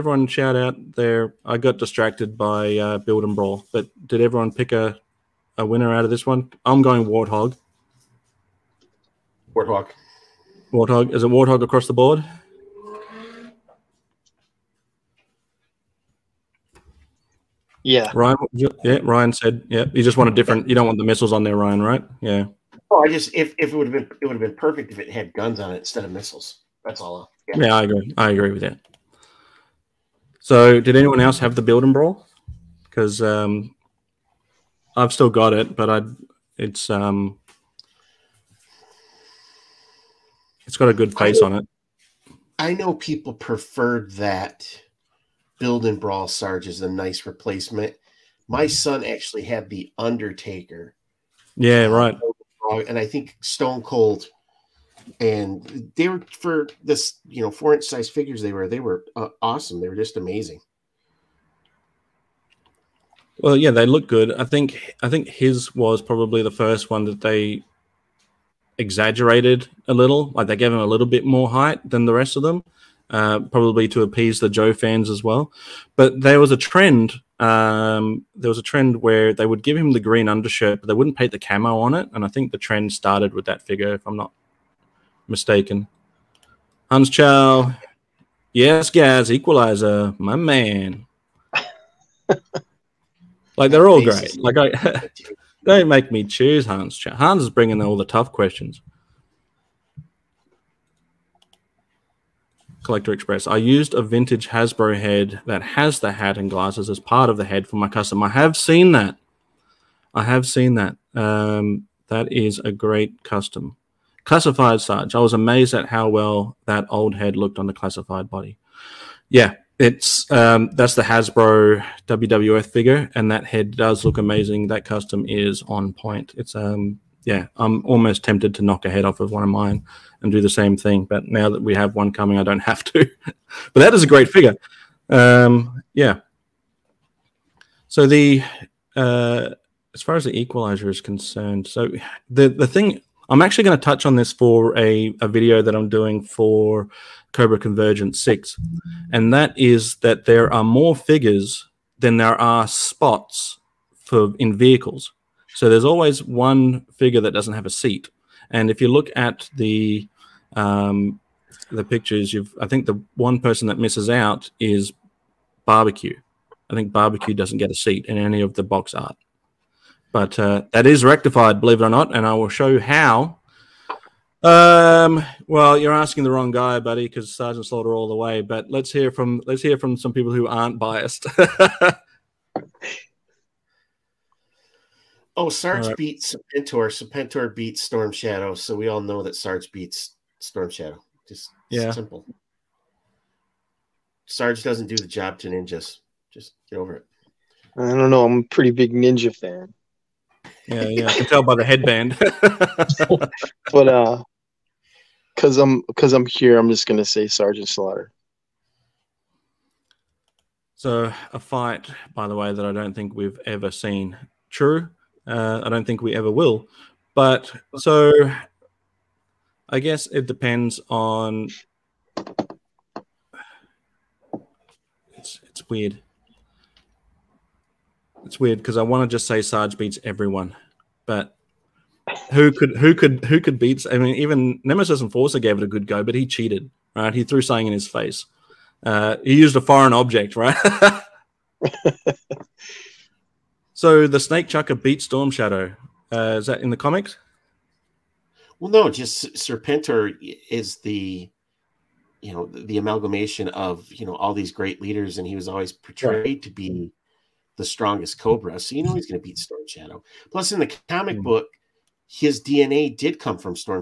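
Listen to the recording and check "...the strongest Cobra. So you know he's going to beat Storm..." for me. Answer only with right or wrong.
right.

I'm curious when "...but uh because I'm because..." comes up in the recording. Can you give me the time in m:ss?
3:23.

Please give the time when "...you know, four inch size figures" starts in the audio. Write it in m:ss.
0:57.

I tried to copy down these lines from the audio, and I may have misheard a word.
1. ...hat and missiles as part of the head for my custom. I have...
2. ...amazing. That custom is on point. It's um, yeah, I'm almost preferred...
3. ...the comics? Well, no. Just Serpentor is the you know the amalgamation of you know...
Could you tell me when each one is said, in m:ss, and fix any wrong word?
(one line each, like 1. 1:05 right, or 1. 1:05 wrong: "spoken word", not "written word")
1. 1:46 wrong: "glasses", not "missiles"
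2. 2:04 wrong: "tempted", not "preferred"
3. 4:06 right.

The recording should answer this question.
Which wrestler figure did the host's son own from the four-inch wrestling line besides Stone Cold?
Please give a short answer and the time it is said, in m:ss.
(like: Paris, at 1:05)
The Undertaker, at 0:49.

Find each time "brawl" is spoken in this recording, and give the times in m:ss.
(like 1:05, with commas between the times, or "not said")
0:03, 0:31, 0:45.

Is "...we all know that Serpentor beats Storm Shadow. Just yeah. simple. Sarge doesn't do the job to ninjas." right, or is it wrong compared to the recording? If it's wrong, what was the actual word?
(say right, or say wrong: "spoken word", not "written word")
wrong: "Sarge", not "Serpentor".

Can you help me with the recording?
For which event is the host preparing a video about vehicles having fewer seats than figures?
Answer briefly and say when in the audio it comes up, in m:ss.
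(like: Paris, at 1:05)
Cobra Convergence 6, at 2:27.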